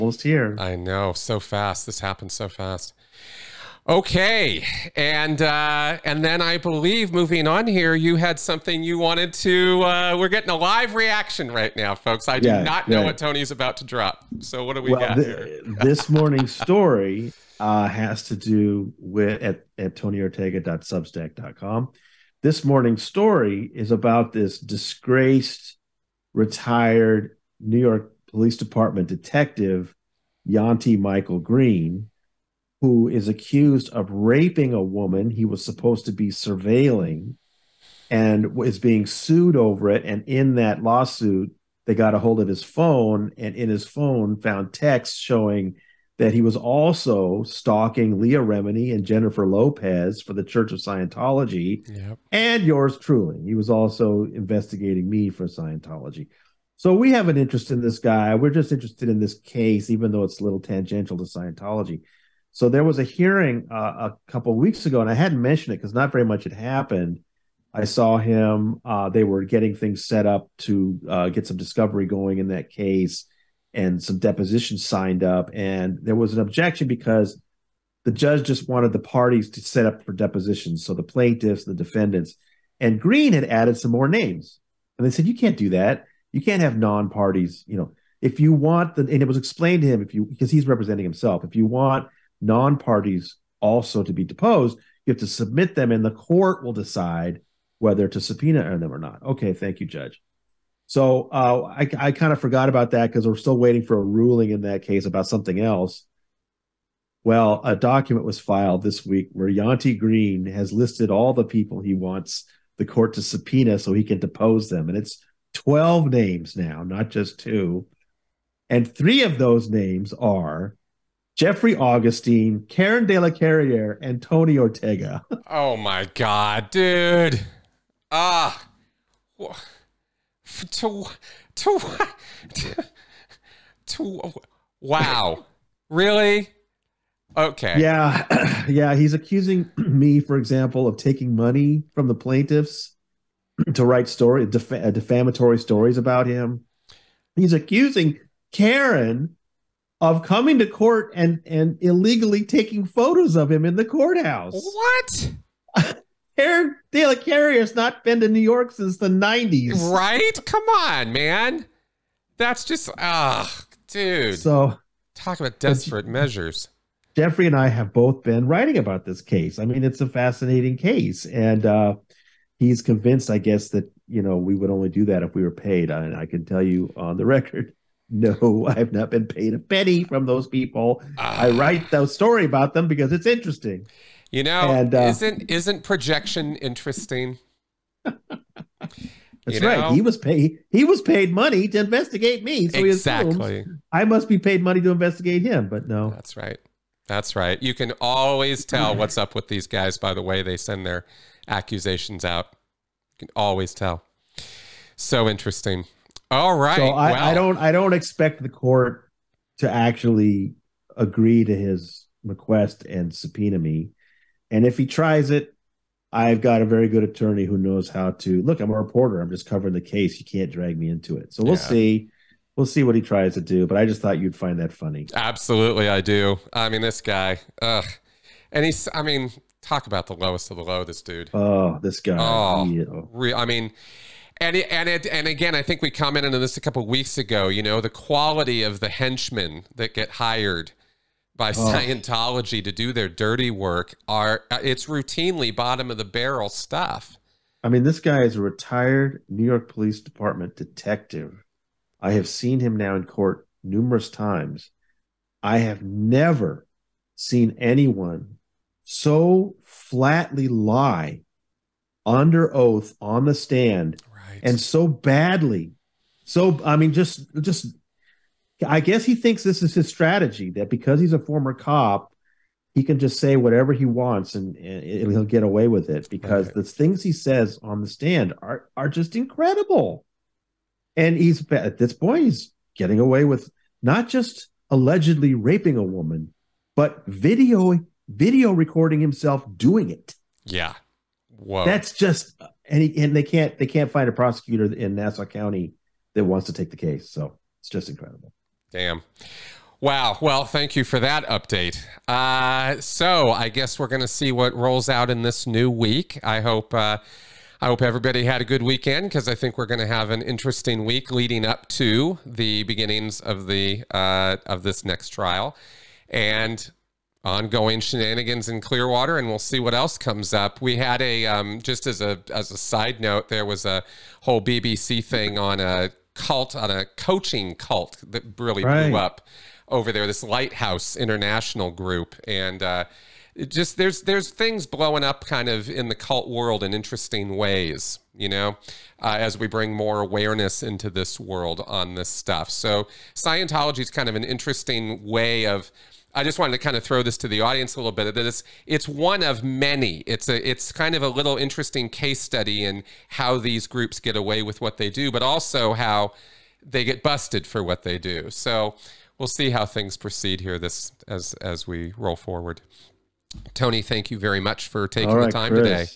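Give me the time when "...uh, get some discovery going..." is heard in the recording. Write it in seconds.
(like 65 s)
71 s.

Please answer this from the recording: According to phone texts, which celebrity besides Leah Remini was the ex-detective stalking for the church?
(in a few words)
Jennifer Lopez.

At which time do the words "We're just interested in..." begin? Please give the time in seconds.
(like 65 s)
58 s.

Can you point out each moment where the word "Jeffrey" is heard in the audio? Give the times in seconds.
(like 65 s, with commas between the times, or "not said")
121 s, 167 s.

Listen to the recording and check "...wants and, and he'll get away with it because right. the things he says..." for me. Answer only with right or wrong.
right.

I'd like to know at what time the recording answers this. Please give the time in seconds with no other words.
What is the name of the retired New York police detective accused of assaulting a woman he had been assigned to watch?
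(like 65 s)
30 s.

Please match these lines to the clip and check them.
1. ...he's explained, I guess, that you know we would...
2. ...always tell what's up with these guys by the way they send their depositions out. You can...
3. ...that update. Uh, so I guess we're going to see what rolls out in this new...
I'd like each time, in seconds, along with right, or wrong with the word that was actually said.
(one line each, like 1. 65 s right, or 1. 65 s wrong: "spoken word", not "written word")
1. 172 s wrong: "convinced", not "explained"
2. 198 s wrong: "accusations", not "depositions"
3. 301 s right.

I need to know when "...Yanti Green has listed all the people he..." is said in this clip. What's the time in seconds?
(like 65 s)
109 s.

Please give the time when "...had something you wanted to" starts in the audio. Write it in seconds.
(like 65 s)
8 s.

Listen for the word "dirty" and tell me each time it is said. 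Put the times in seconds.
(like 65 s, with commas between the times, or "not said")
243 s.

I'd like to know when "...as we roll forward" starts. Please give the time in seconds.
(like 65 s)
361 s.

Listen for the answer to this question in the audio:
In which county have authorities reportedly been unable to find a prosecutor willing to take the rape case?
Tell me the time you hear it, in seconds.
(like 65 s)
294 s.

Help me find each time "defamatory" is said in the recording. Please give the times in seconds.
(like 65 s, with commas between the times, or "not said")
144 s.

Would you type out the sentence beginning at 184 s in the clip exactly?
You know, and, uh, isn't isn't projection interesting?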